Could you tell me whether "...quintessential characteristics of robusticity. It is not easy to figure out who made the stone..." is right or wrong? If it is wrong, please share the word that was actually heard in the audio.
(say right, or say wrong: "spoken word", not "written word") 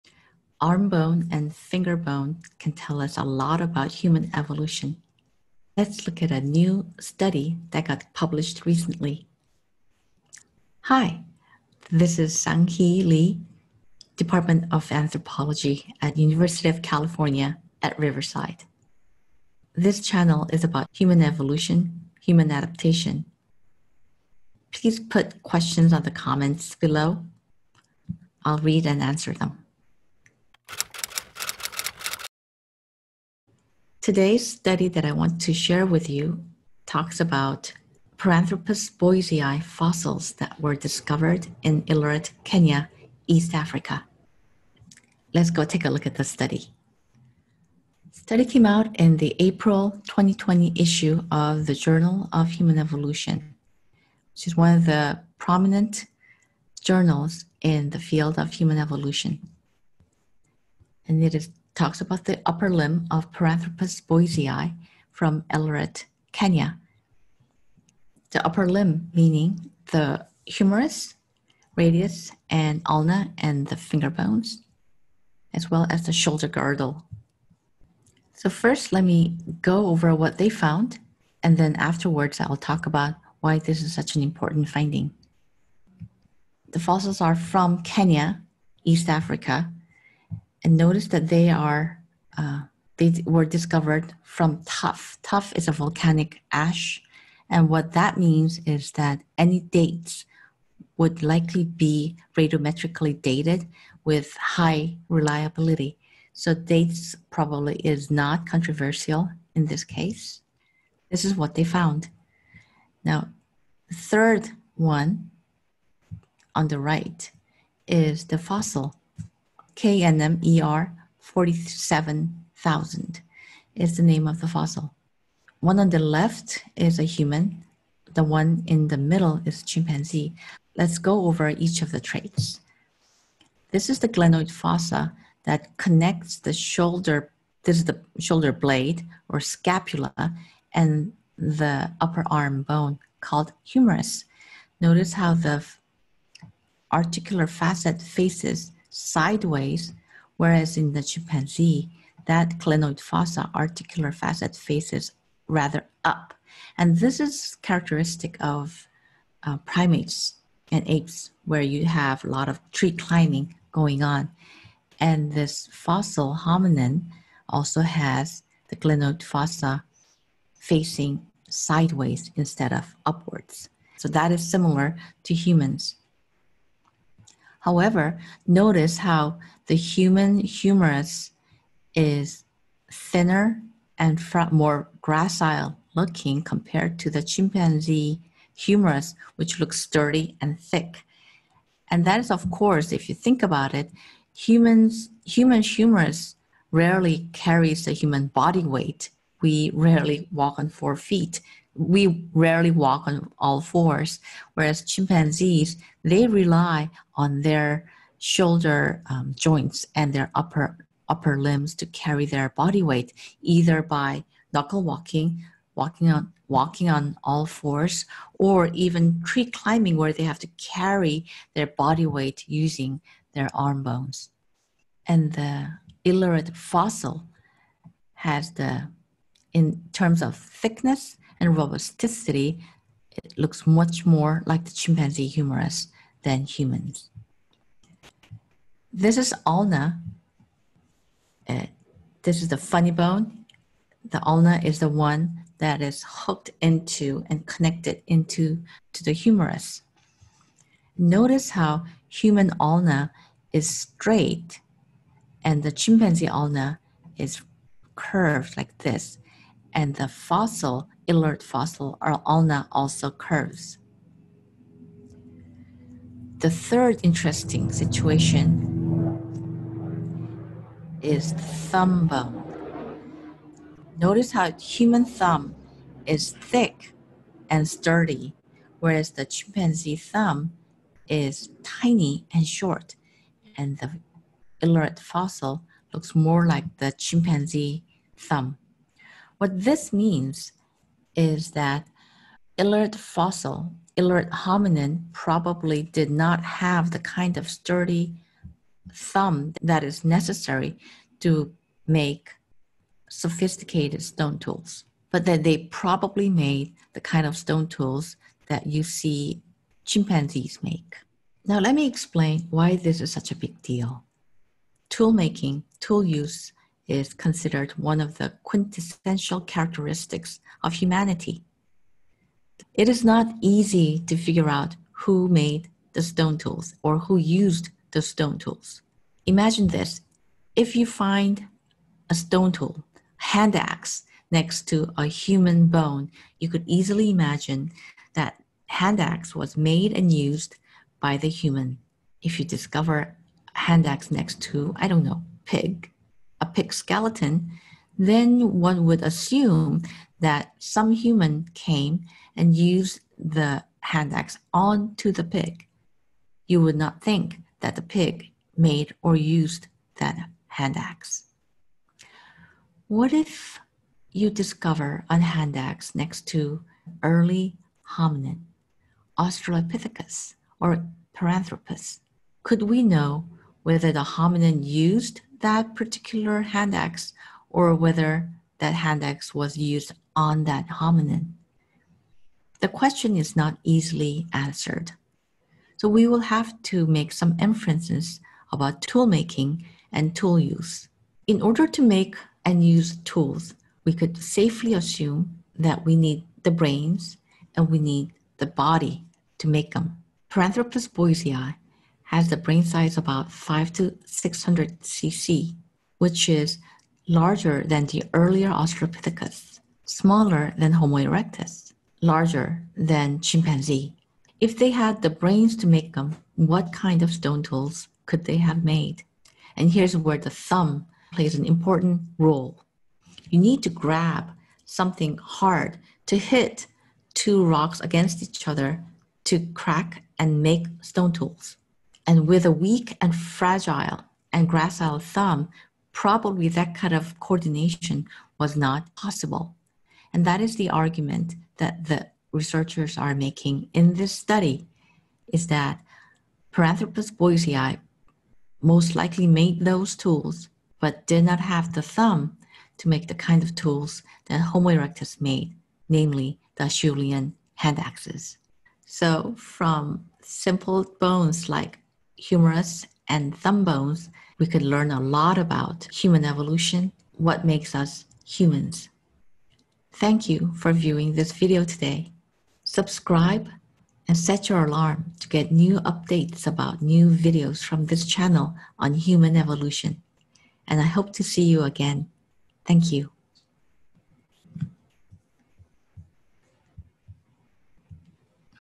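wrong: "humanity", not "robusticity".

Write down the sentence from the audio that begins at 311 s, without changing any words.
Now, let me explain why this is such a big deal.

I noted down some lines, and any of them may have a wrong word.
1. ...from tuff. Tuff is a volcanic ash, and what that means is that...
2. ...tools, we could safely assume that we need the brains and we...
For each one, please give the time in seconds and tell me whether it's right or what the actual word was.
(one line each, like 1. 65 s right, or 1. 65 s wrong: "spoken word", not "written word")
1. 94 s right
2. 392 s right.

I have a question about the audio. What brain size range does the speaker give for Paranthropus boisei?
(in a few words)
500 to 600 cc.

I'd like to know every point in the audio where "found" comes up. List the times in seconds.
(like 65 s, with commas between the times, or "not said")
80 s, 111 s.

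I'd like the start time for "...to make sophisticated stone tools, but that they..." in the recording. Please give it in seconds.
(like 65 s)
301 s.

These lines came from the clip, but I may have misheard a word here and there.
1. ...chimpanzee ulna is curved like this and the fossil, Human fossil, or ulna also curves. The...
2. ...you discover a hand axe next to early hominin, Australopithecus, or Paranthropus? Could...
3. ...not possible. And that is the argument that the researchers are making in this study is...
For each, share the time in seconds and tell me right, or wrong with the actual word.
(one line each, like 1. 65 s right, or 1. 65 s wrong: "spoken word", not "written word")
1. 255 s wrong: "Ileret", not "Human"
2. 364 s right
3. 438 s right.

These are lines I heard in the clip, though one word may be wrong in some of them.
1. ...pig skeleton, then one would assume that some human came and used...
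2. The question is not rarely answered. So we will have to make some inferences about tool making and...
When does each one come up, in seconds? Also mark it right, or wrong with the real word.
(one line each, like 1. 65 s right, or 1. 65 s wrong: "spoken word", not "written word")
1. 346 s right
2. 382 s wrong: "easily", not "rarely".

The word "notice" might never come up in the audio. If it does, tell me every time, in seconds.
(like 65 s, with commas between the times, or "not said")
90 s, 144 s, 178 s, 250 s, 273 s.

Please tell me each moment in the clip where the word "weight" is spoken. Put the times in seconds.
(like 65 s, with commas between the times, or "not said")
198 s, 212 s, 222 s.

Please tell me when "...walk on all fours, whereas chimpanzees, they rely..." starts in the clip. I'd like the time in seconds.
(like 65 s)
202 s.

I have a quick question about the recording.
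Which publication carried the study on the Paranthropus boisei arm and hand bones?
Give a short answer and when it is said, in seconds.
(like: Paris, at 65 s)
Journal of Human Evolution, at 51 s.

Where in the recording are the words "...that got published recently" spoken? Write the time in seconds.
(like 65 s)
7 s.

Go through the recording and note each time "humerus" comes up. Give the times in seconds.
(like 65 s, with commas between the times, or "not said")
70 s, 143 s, 180 s, 188 s, 195 s, 235 s, 249 s, 462 s.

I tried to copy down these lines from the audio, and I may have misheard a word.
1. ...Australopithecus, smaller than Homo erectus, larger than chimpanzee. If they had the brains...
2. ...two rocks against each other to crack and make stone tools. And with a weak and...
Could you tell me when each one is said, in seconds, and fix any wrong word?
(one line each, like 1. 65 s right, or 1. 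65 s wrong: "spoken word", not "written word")
1. 408 s right
2. 427 s right.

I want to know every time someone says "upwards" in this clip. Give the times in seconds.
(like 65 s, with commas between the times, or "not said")
173 s.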